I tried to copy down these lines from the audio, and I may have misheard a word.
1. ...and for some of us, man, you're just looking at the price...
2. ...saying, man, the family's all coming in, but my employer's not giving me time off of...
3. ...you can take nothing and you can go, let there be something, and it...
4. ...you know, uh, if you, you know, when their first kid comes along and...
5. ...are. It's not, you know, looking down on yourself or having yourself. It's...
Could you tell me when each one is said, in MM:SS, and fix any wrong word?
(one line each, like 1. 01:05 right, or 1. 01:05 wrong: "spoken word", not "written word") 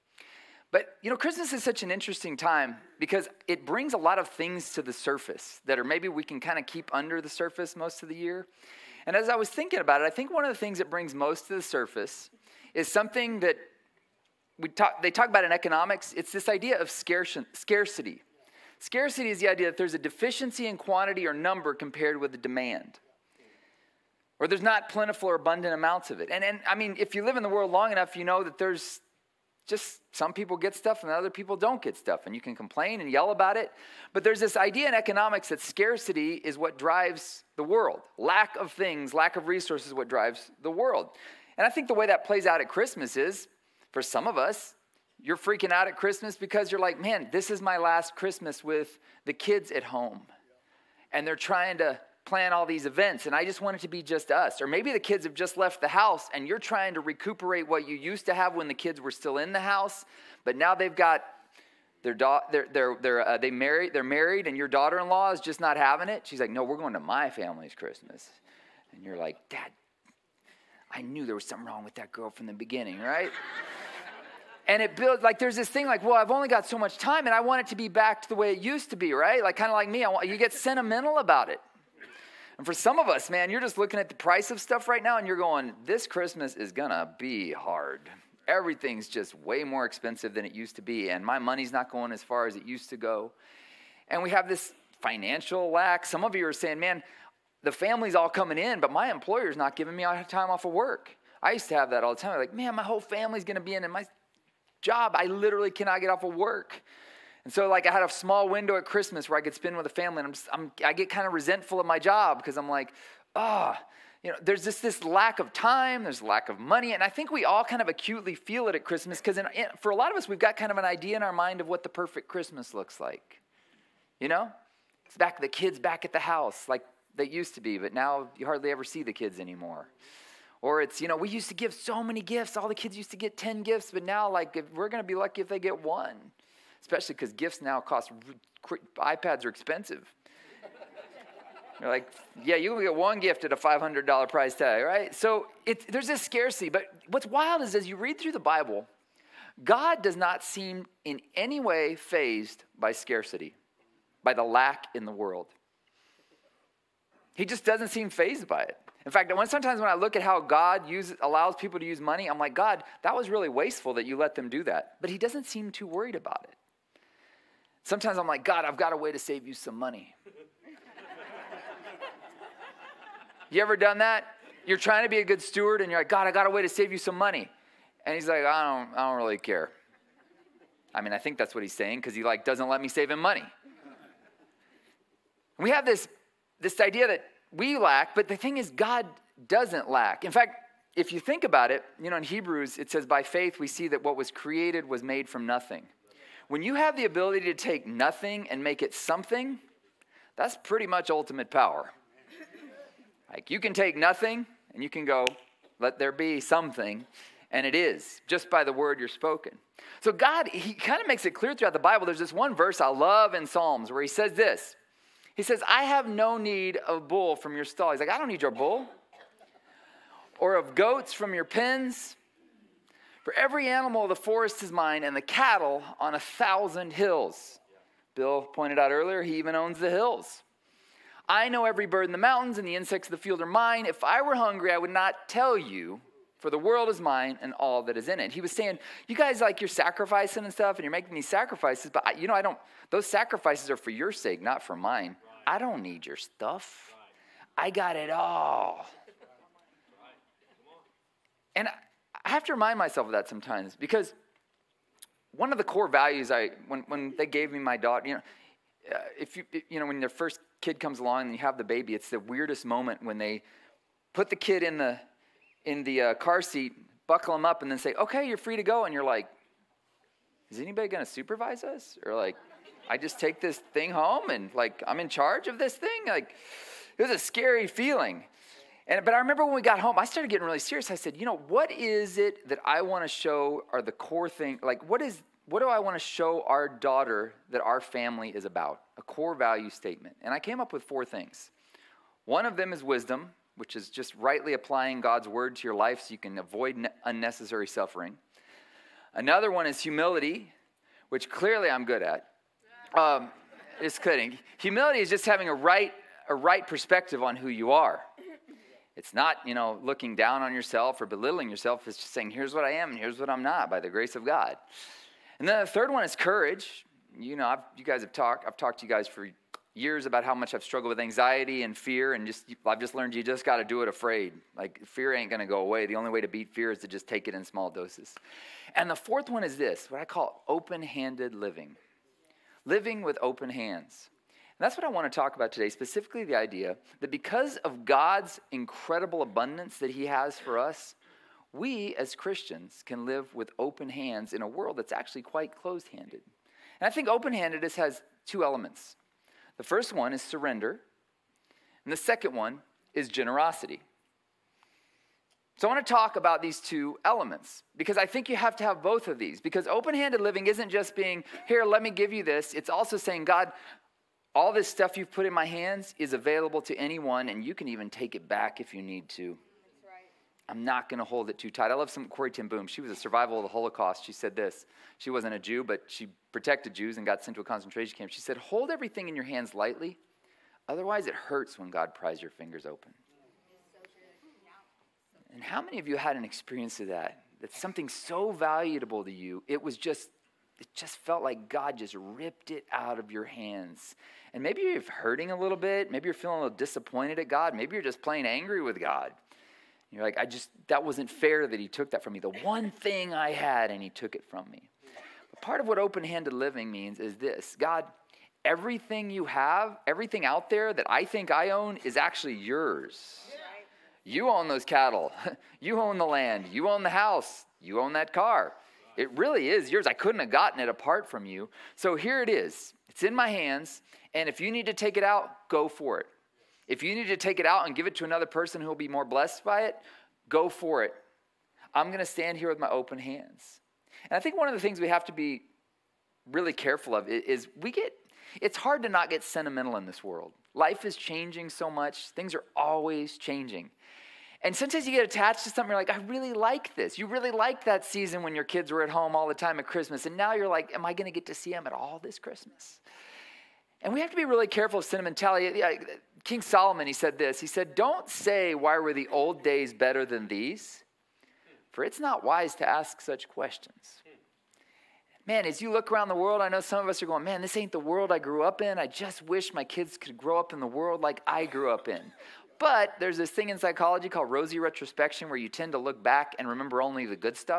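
1. 01:22 right
2. 01:36 right
3. 03:23 right
4. 04:18 right
5. 05:07 wrong: "belittling", not "having".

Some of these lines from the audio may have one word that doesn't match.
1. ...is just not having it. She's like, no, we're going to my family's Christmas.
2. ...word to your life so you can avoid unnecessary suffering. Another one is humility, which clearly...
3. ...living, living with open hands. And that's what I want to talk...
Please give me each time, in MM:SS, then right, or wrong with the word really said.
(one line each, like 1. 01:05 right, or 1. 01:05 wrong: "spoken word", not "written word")
1. 01:05 right
2. 04:55 right
3. 05:31 right.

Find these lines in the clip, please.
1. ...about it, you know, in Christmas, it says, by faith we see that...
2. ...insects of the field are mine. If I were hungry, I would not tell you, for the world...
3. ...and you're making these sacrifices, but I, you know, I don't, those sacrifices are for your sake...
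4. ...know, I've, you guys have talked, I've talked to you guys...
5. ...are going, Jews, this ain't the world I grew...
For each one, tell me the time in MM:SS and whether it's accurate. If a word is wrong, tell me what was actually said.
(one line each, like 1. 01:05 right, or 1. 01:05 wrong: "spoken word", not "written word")
1. 03:11 wrong: "Hebrews", not "Christmas"
2. 03:52 right
3. 04:00 right
4. 05:17 right
5. 07:47 wrong: "Man", not "Jews".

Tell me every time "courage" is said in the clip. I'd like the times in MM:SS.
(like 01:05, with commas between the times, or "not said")
05:16.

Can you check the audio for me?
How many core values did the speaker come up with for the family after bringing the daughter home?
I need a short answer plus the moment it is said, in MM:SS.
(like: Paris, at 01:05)
4, at 04:50.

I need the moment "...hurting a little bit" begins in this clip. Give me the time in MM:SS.
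06:34.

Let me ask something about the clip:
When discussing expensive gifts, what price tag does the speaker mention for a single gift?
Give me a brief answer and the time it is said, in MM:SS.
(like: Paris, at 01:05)
$500, at 02:23.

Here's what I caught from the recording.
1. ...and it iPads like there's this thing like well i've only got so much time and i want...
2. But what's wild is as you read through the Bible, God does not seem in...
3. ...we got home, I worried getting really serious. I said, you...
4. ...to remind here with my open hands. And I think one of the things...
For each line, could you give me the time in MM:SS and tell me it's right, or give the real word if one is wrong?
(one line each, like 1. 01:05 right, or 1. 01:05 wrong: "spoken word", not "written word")
1. 01:14 wrong: "builds", not "iPads"
2. 02:26 right
3. 04:39 wrong: "started", not "worried"
4. 07:11 wrong: "stand", not "remind".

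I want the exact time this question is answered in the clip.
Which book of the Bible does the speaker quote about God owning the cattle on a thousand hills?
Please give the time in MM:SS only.
03:33.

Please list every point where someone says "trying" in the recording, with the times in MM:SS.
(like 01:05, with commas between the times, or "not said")
00:51, 00:56, 02:54.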